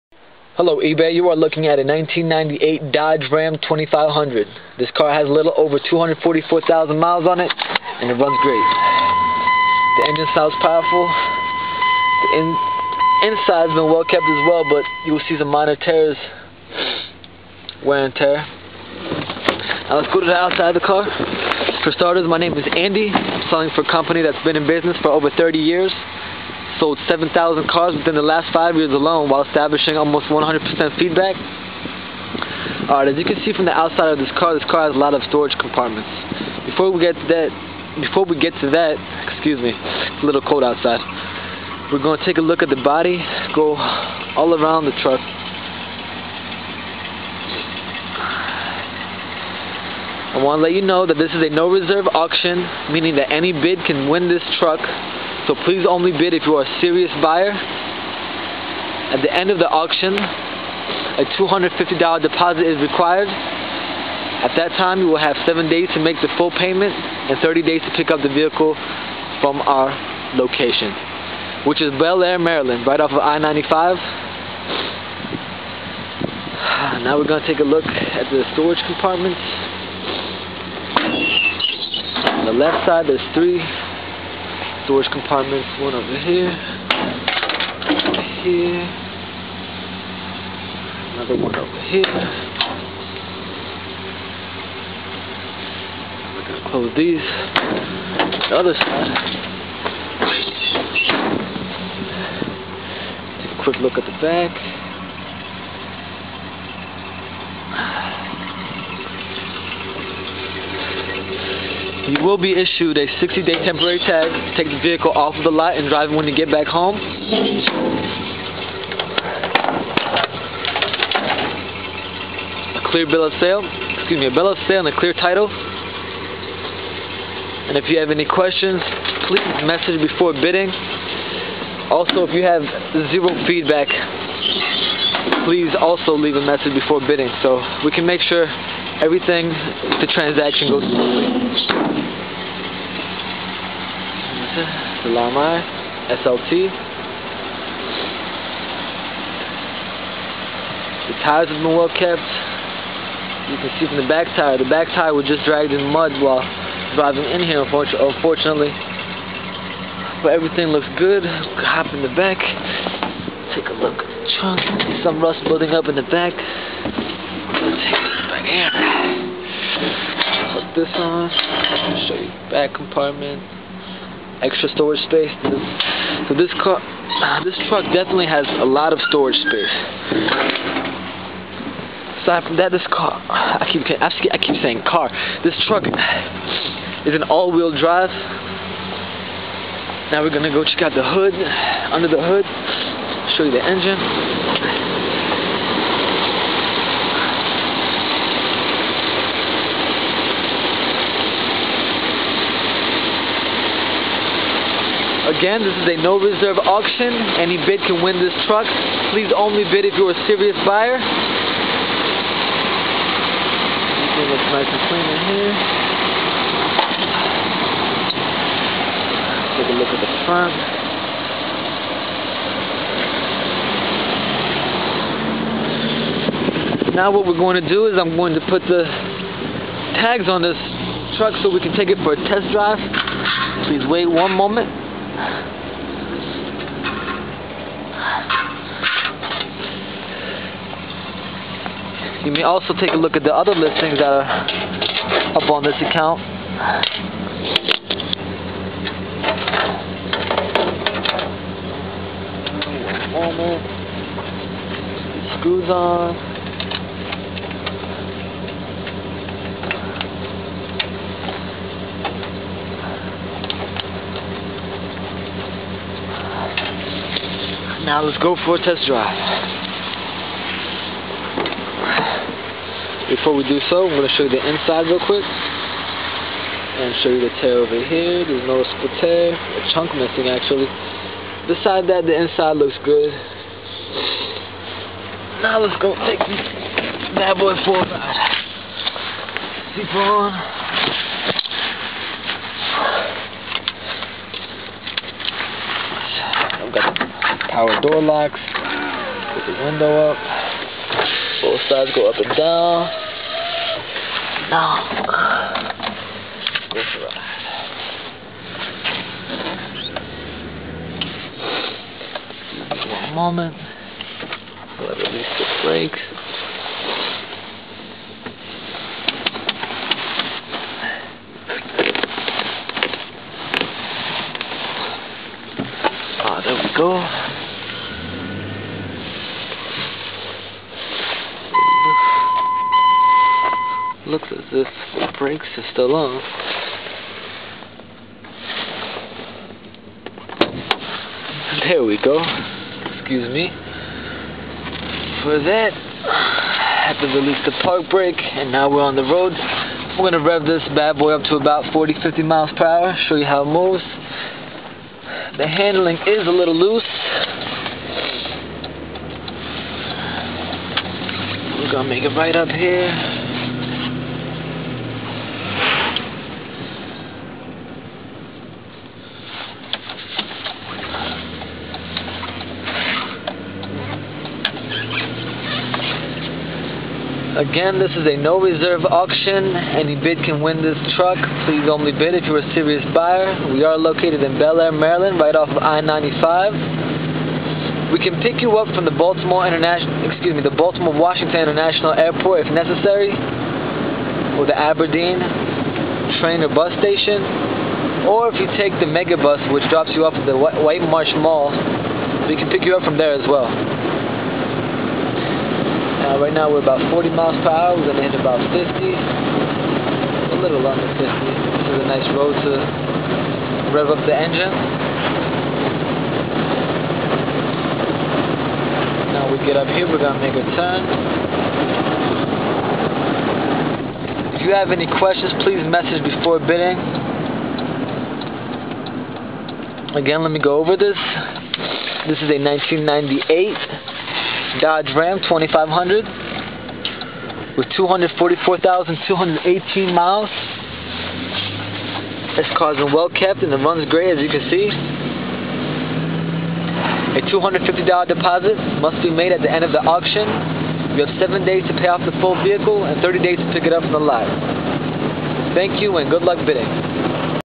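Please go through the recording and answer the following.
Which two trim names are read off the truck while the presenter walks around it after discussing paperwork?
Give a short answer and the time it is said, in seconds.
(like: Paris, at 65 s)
Laramie, SLT, at 144 s.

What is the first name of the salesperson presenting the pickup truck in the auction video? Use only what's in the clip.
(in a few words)
Andy.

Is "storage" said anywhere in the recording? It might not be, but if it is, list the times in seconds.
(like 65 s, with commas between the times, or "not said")
35 s, 78 s, 84 s, 174 s, 179 s.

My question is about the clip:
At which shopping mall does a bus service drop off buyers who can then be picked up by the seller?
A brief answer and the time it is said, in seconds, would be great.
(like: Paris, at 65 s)
White Marsh Mall, at 400 s.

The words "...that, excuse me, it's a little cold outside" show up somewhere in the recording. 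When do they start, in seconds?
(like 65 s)
38 s.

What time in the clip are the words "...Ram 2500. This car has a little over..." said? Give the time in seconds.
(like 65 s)
3 s.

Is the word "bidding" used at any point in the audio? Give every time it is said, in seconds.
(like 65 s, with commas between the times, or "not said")
130 s, 137 s, 426 s, 456 s.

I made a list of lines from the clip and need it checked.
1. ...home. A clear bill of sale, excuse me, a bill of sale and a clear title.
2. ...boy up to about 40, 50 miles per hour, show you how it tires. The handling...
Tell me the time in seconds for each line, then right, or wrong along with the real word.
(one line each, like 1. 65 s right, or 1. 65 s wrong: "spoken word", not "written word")
1. 116 s right
2. 350 s wrong: "moves", not "tires".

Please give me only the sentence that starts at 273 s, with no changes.
Before we do so, I'm going to show you the inside real quick.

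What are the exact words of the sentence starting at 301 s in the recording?
Both sides go up and down.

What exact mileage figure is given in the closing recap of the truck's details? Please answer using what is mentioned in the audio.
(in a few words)
244,218 miles.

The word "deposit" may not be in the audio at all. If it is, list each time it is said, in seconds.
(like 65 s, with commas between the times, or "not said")
62 s, 448 s.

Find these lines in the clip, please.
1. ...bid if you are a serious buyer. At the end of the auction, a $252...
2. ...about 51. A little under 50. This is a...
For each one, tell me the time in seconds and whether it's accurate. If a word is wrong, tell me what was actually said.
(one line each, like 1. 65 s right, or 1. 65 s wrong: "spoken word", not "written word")
1. 56 s wrong: "250", not "252"
2. 408 s wrong: "50", not "51".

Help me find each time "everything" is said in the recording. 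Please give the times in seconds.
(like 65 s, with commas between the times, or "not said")
139 s, 160 s, 214 s.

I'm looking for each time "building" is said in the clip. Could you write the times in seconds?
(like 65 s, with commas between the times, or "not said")
165 s.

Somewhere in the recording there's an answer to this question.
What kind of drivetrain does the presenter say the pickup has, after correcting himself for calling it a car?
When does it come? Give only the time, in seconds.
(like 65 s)
187 s.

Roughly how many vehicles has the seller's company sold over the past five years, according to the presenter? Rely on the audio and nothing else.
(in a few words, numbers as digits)
7,000.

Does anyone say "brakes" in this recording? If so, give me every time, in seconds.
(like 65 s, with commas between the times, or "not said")
315 s, 335 s, 347 s.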